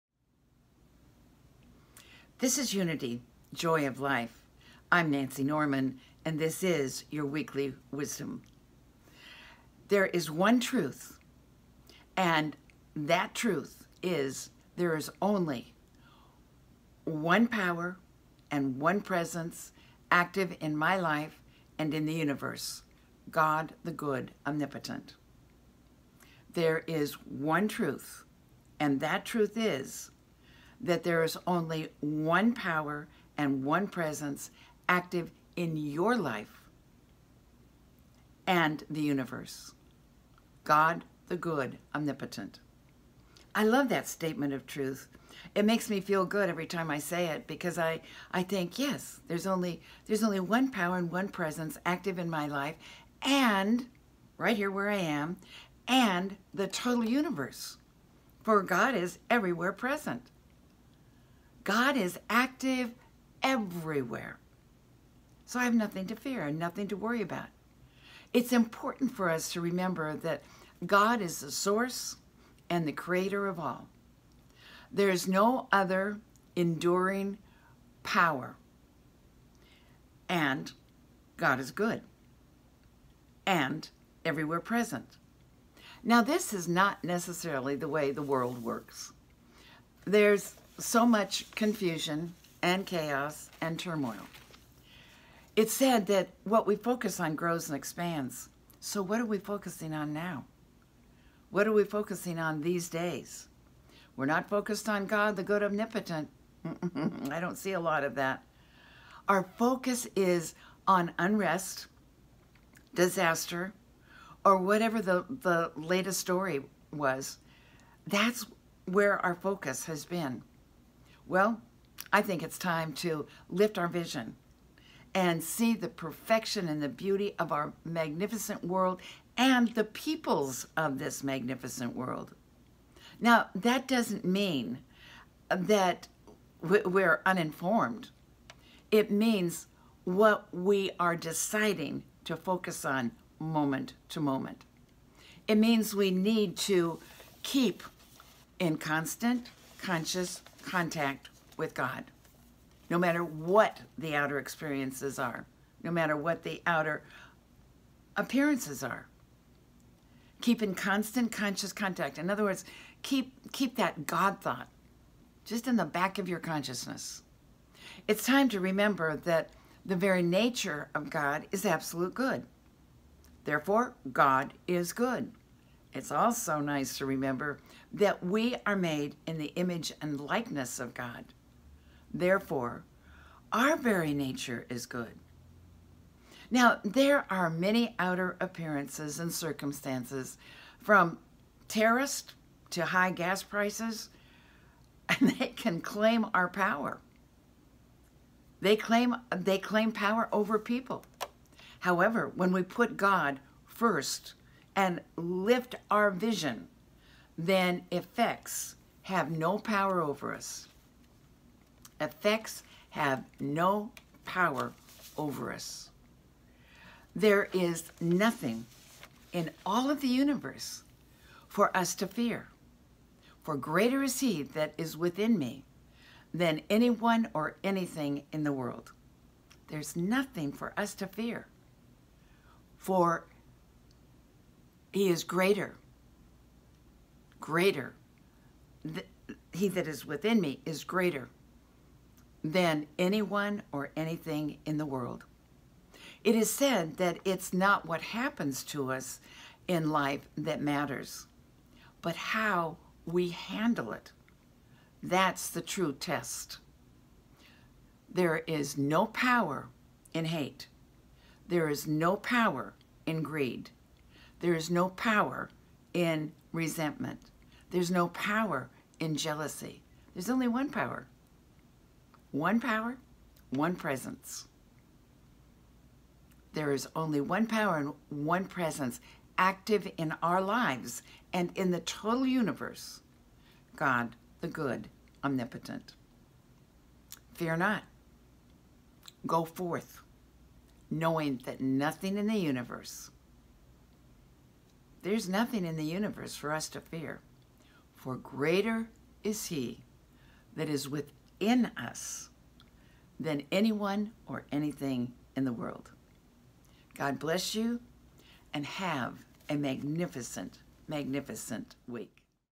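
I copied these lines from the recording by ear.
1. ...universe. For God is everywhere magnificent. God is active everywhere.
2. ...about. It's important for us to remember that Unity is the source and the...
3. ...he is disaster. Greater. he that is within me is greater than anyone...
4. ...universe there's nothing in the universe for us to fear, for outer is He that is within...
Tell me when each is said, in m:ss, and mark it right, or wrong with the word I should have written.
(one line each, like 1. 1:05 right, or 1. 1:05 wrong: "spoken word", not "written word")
1. 0:57 wrong: "present", not "magnificent"
2. 1:07 wrong: "God", not "Unity"
3. 3:54 wrong: "greater", not "disaster"
4. 4:52 wrong: "greater", not "outer".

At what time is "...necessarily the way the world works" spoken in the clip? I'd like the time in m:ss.
1:27.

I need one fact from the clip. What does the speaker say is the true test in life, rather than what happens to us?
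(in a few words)
how we handle it.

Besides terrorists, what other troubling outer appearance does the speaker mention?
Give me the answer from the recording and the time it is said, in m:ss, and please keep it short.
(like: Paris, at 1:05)
high gas prices, at 3:12.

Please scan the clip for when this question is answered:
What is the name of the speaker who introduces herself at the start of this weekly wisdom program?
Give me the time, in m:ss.
0:05.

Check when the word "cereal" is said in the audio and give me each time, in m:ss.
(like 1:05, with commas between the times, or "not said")
not said.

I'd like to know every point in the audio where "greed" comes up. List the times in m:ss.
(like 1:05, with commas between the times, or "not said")
4:23.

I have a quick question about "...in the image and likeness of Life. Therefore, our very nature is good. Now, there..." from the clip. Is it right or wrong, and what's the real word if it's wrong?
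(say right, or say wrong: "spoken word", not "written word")
wrong: "God", not "Life".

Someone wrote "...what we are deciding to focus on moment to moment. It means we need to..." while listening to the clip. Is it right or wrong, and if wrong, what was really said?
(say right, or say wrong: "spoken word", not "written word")
right.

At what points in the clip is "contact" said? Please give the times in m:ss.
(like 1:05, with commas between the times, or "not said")
2:30, 2:41.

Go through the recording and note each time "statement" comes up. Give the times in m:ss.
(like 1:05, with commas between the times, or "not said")
0:44.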